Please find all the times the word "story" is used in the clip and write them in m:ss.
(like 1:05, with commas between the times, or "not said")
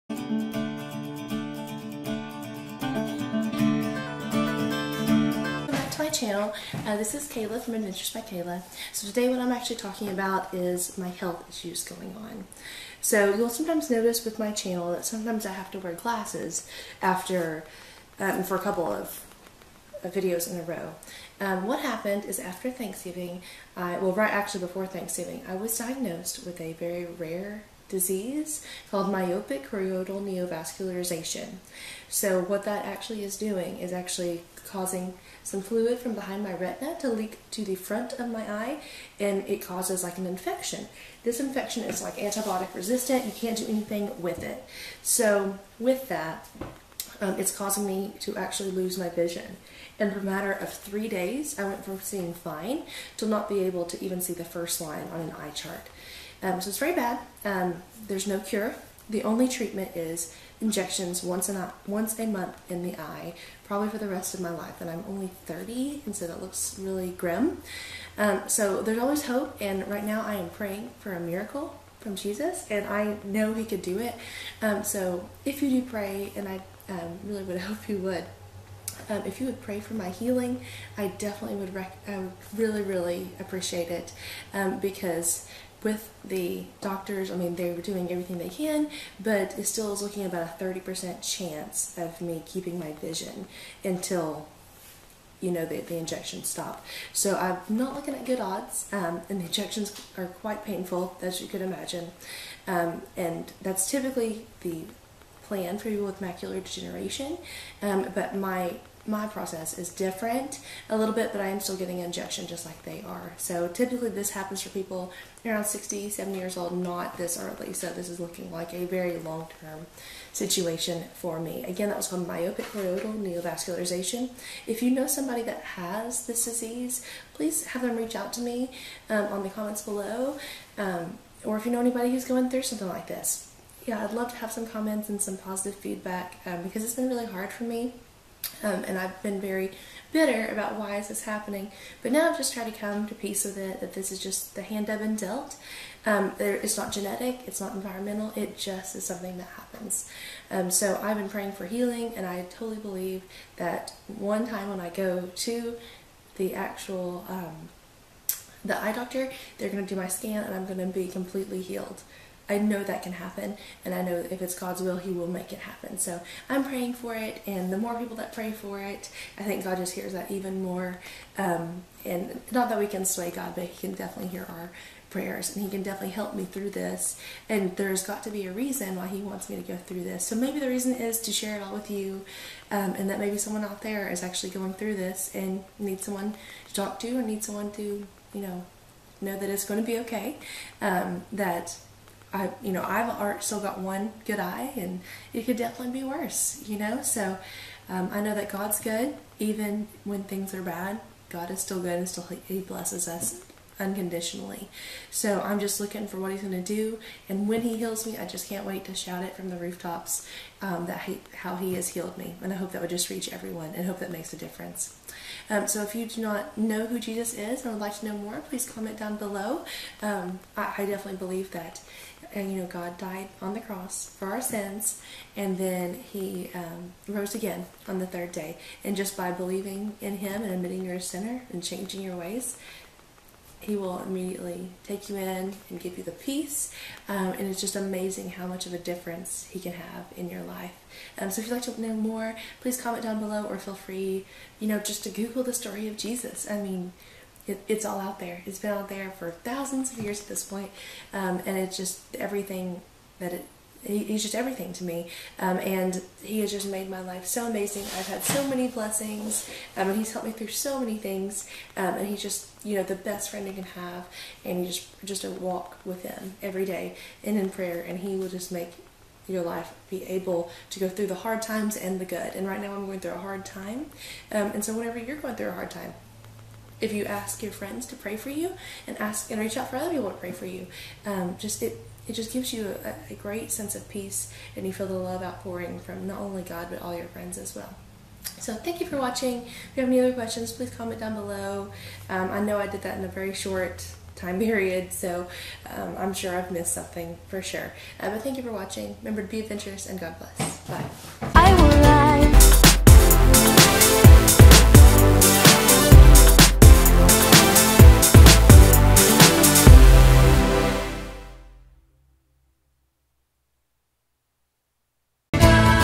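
4:05.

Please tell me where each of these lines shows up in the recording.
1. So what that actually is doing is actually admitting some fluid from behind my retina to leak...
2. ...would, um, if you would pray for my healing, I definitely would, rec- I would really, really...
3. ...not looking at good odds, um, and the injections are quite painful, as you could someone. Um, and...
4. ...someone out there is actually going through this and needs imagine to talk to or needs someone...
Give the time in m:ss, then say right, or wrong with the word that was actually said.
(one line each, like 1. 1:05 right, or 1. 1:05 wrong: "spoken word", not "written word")
1. 0:32 wrong: "causing", not "admitting"
2. 1:17 right
3. 1:37 wrong: "imagine", not "someone"
4. 3:03 wrong: "someone", not "imagine".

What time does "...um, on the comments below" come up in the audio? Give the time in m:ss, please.
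2:09.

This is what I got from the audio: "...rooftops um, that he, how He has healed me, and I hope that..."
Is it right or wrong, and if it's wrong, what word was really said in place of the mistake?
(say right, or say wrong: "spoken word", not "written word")
right.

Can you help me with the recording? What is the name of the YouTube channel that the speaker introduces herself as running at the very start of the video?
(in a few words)
Adventures by Kayla.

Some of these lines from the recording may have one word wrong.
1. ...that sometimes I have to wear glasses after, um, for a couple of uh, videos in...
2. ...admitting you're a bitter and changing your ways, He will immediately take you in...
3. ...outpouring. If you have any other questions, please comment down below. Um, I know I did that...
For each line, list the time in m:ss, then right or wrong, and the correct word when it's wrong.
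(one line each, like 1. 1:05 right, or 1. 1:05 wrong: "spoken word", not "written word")
1. 0:14 right
2. 3:50 wrong: "sinner", not "bitter"
3. 4:48 wrong: "watching", not "outpouring".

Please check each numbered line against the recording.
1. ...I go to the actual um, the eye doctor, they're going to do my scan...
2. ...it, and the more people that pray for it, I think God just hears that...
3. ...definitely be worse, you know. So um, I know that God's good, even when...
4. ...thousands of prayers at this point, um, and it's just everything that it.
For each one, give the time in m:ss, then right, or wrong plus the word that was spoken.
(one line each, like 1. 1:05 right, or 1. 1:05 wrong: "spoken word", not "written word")
1. 2:34 right
2. 2:47 right
3. 3:15 right
4. 4:09 wrong: "years", not "prayers".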